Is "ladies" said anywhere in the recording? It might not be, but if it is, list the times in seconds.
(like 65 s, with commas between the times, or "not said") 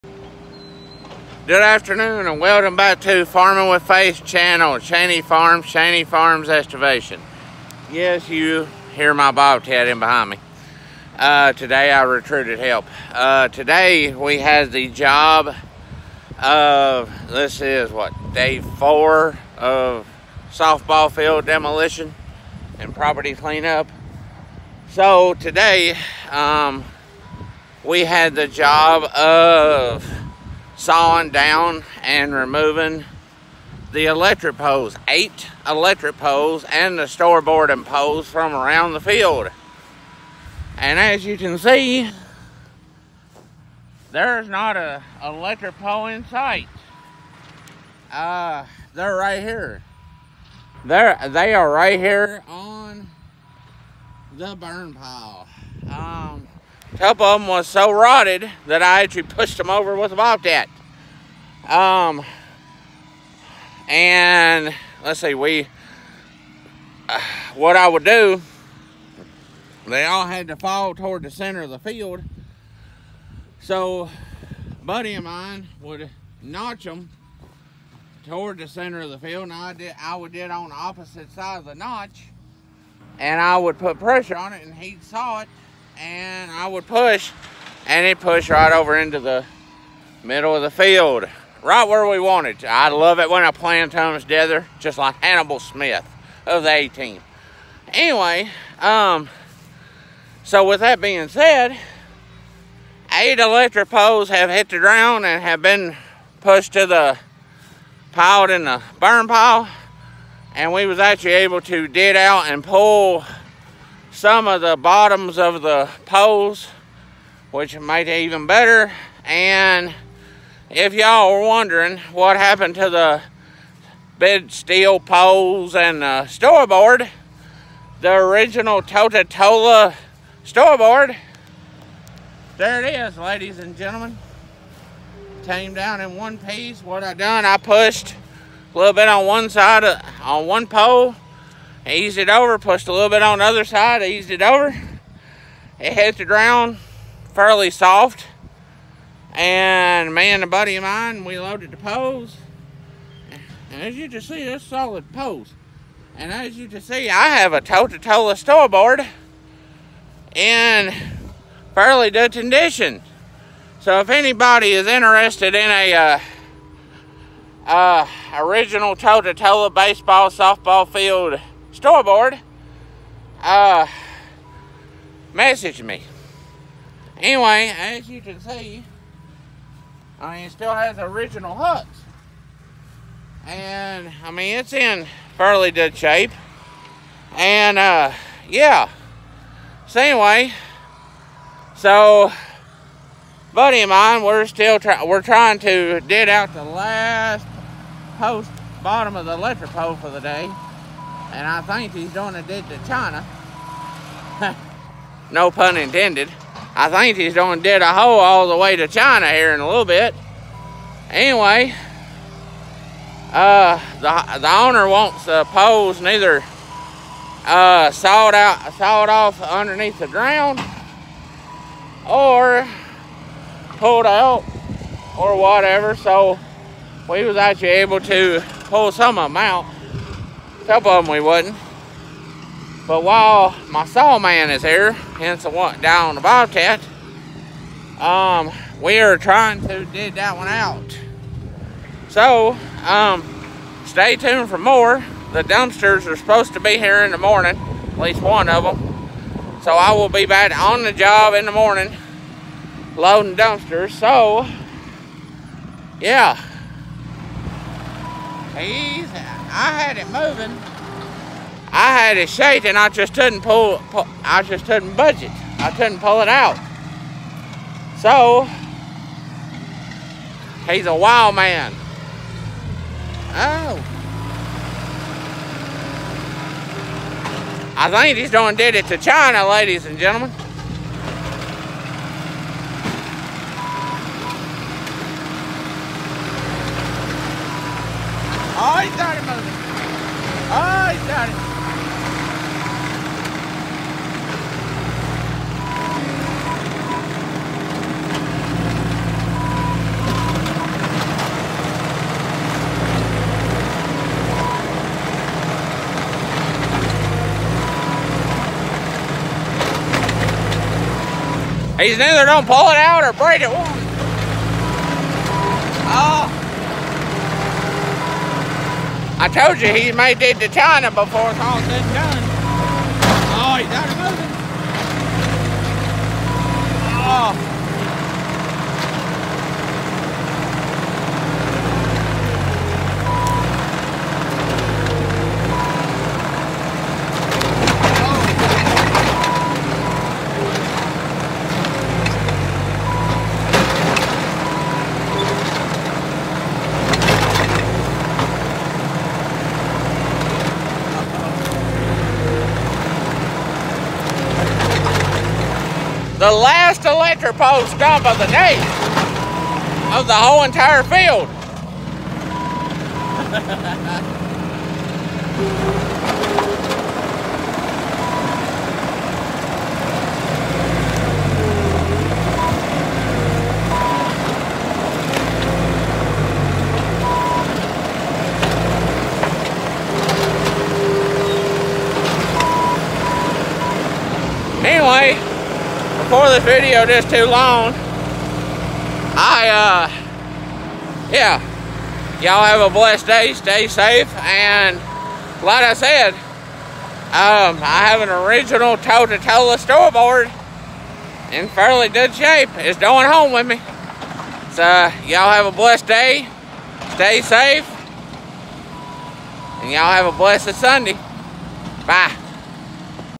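133 s, 279 s.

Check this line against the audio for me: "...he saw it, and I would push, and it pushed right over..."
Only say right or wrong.
right.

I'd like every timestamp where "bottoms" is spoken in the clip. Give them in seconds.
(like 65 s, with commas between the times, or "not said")
114 s, 198 s.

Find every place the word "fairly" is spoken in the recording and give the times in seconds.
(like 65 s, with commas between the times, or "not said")
147 s, 161 s, 185 s, 401 s.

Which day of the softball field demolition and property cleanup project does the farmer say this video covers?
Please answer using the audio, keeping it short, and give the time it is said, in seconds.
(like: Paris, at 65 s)
Day 4, at 18 s.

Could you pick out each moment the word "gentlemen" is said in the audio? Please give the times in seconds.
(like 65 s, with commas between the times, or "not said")
133 s, 279 s.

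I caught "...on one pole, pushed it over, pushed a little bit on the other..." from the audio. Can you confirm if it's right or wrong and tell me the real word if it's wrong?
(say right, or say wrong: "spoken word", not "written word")
wrong: "eased", not "pushed".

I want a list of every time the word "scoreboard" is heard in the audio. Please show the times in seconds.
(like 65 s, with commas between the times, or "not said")
37 s, 126 s, 130 s, 158 s, 171 s, 399 s.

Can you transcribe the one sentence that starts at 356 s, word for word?
the last electric pole stump of the day of the whole entire field.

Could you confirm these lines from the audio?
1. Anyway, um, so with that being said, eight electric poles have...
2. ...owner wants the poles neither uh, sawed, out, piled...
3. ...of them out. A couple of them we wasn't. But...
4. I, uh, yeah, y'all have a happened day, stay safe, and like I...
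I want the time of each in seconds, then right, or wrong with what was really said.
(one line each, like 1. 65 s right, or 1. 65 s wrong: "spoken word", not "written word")
1. 97 s right
2. 214 s wrong: "sawed", not "piled"
3. 229 s right
4. 389 s wrong: "blessed", not "happened".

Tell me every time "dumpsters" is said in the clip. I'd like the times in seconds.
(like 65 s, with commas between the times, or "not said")
245 s, 253 s.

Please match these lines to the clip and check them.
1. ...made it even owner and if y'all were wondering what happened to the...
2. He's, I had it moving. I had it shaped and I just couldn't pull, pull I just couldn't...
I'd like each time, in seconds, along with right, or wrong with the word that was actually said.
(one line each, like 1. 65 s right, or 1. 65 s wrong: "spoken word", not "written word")
1. 117 s wrong: "better", not "owner"
2. 258 s right.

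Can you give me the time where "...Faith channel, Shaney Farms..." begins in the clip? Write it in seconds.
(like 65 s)
3 s.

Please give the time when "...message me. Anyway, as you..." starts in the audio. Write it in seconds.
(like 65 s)
175 s.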